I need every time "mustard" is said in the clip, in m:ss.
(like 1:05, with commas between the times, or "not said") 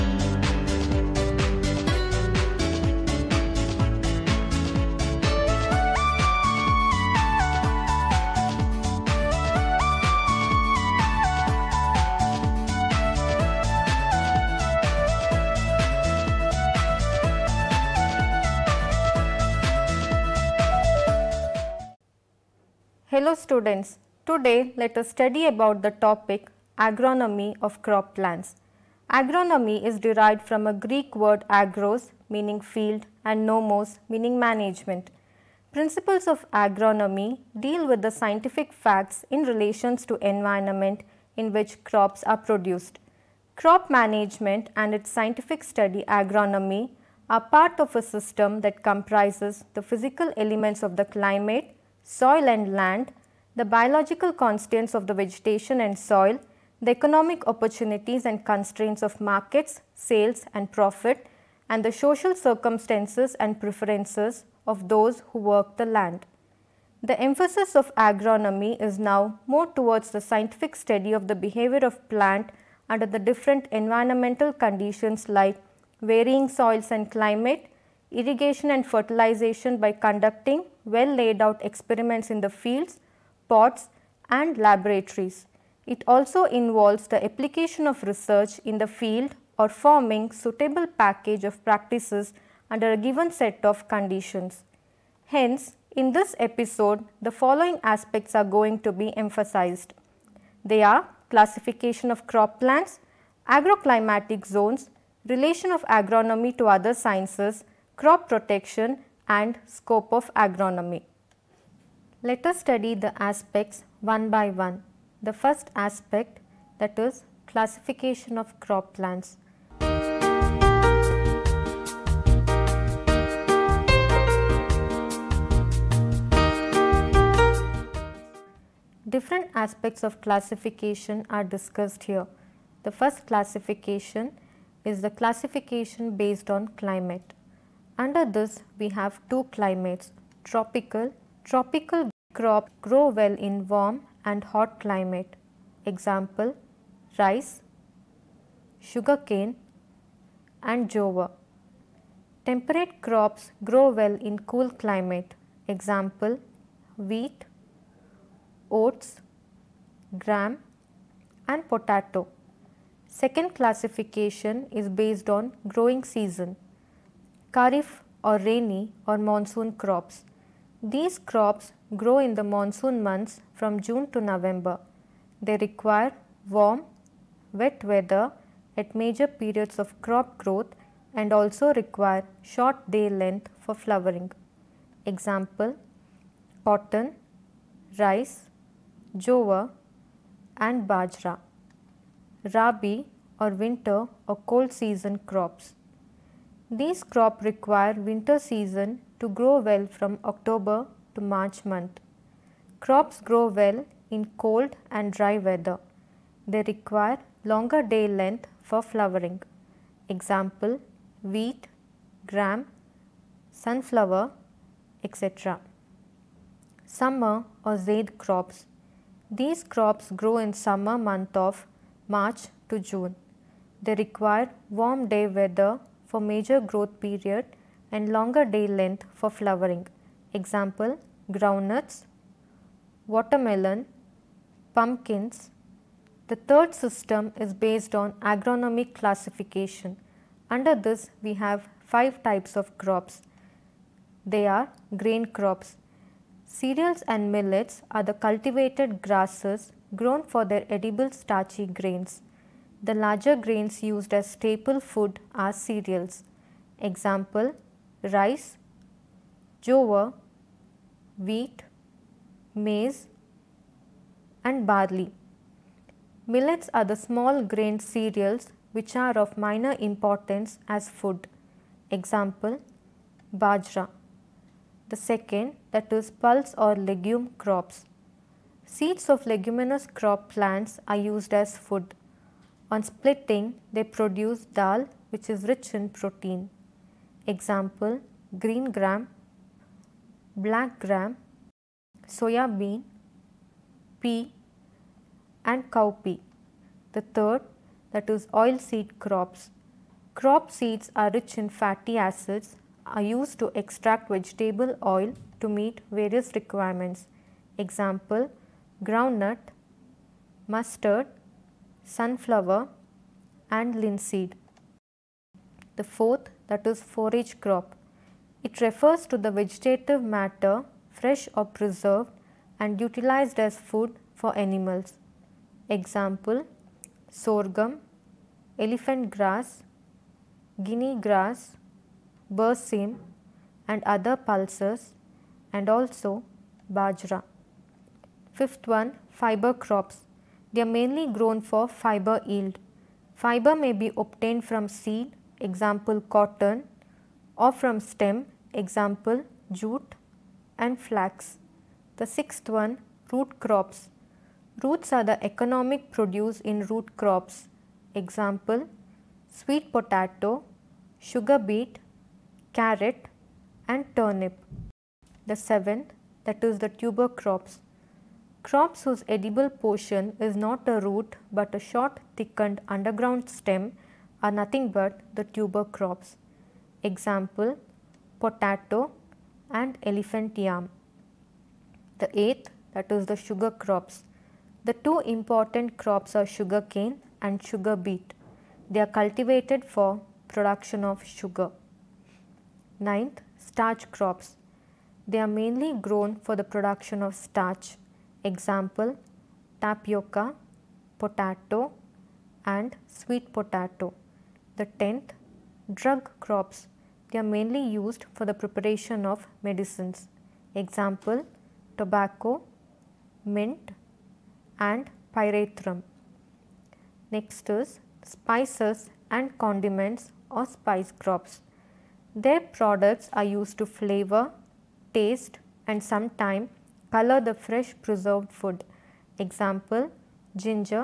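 5:10.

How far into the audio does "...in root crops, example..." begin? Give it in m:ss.
5:56.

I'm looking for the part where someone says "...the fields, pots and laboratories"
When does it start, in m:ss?
1:22.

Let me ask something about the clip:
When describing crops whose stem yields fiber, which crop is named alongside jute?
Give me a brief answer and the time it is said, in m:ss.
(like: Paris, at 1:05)
flax, at 5:50.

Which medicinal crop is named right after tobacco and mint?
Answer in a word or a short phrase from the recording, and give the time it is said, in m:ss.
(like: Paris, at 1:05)
pyrethrum, at 6:55.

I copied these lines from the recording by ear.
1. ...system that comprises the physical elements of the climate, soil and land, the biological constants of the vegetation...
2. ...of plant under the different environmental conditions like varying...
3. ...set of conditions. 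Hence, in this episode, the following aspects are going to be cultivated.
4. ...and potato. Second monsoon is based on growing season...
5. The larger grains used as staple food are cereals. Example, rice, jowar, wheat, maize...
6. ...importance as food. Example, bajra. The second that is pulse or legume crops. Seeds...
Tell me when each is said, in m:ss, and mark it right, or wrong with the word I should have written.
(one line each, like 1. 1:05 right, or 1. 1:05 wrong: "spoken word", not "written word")
1. 0:48 right
2. 1:11 right
3. 1:33 wrong: "emphasized", not "cultivated"
4. 2:41 wrong: "classification", not "monsoon"
5. 4:12 right
6. 4:29 right.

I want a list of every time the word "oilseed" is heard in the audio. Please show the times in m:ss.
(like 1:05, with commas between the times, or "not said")
4:58.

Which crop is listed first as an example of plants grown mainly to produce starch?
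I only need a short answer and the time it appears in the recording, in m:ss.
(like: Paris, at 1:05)
tapioca, at 6:39.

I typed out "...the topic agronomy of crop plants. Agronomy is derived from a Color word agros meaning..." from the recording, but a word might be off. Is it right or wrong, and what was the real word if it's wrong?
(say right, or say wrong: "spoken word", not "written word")
wrong: "Greek", not "Color".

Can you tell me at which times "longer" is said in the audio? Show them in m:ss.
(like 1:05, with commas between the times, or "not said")
3:27, 3:48.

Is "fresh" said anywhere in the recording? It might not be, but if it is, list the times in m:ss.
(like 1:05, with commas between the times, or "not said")
5:20, 7:07.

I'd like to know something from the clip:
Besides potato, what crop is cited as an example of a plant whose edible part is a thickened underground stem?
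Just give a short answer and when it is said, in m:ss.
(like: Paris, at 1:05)
elephant yam, at 6:19.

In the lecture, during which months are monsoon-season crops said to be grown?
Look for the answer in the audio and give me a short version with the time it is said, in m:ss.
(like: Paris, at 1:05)
June to November, at 2:53.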